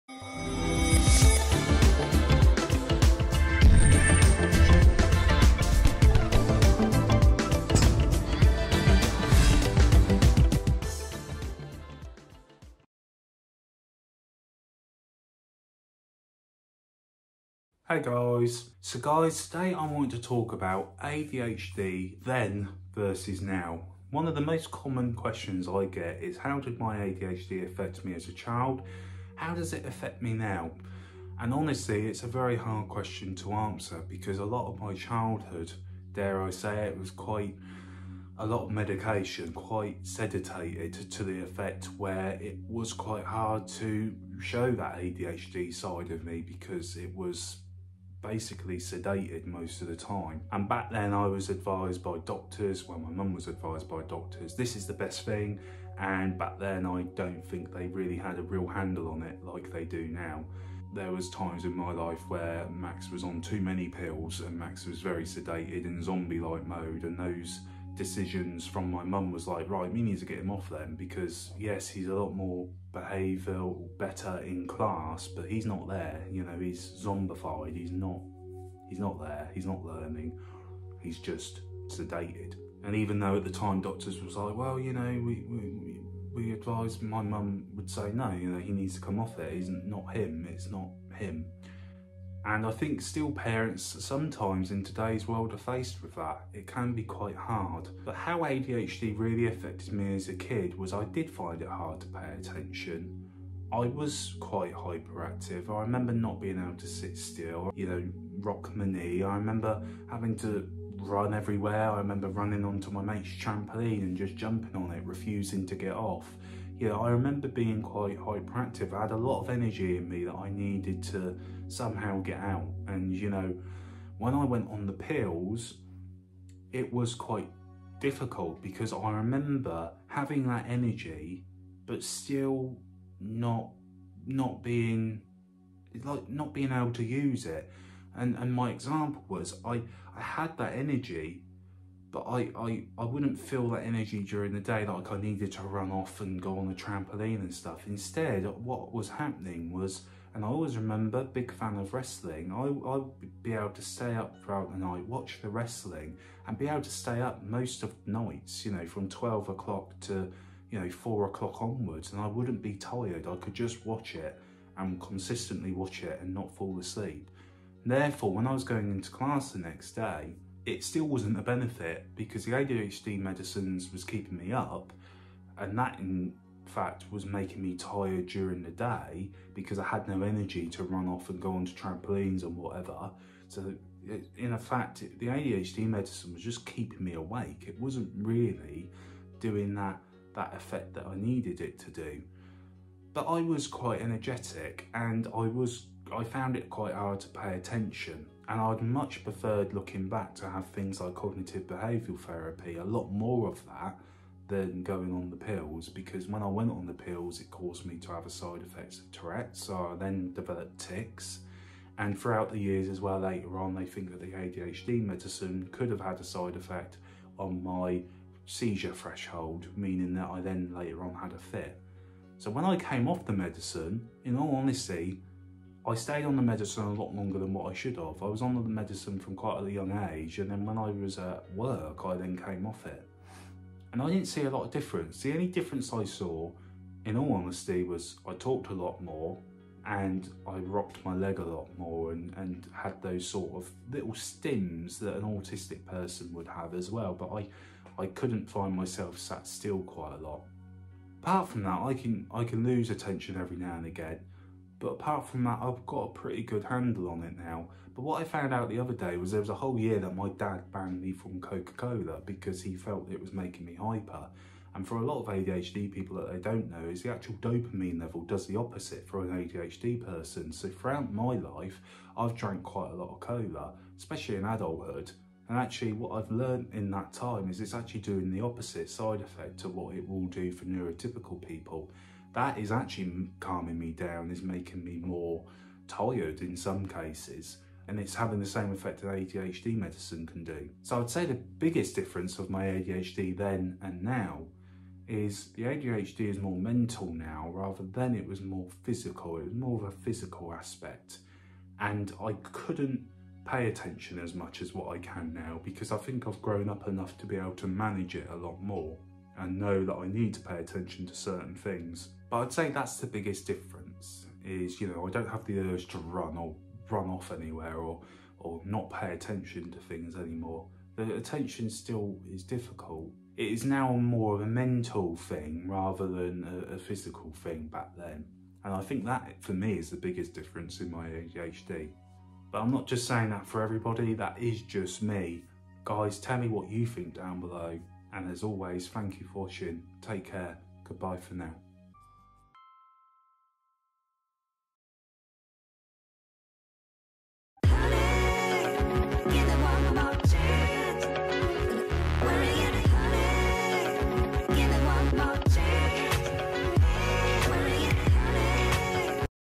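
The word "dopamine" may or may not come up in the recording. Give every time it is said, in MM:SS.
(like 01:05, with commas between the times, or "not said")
04:27.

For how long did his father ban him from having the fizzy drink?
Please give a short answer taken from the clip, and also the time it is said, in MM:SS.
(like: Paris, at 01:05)
a whole year, at 04:19.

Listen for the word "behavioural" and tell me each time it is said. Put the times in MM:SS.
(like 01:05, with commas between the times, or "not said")
01:12, 03:21.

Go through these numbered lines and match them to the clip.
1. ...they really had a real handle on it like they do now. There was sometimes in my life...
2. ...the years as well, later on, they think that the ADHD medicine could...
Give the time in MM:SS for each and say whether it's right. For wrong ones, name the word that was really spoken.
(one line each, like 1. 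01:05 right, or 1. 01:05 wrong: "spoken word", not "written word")
1. 00:57 wrong: "times", not "sometimes"
2. 03:32 right.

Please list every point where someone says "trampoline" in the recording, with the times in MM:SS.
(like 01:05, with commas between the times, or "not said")
01:53, 02:26, 03:01.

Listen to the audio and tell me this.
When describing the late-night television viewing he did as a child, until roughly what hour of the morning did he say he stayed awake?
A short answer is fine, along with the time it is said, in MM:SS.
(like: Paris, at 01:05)
4 o'clock, at 02:40.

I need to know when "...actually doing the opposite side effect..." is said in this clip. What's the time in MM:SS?
04:37.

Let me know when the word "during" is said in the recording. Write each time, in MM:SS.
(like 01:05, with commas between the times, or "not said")
02:24, 02:58.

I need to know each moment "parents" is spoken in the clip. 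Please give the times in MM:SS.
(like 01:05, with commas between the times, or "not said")
01:33.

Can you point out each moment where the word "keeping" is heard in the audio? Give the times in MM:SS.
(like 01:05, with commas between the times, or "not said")
02:54, 03:06.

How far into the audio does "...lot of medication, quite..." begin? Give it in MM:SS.
00:38.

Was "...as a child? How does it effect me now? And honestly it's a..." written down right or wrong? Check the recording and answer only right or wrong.
wrong.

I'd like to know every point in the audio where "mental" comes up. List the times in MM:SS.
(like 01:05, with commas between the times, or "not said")
04:56, 05:24.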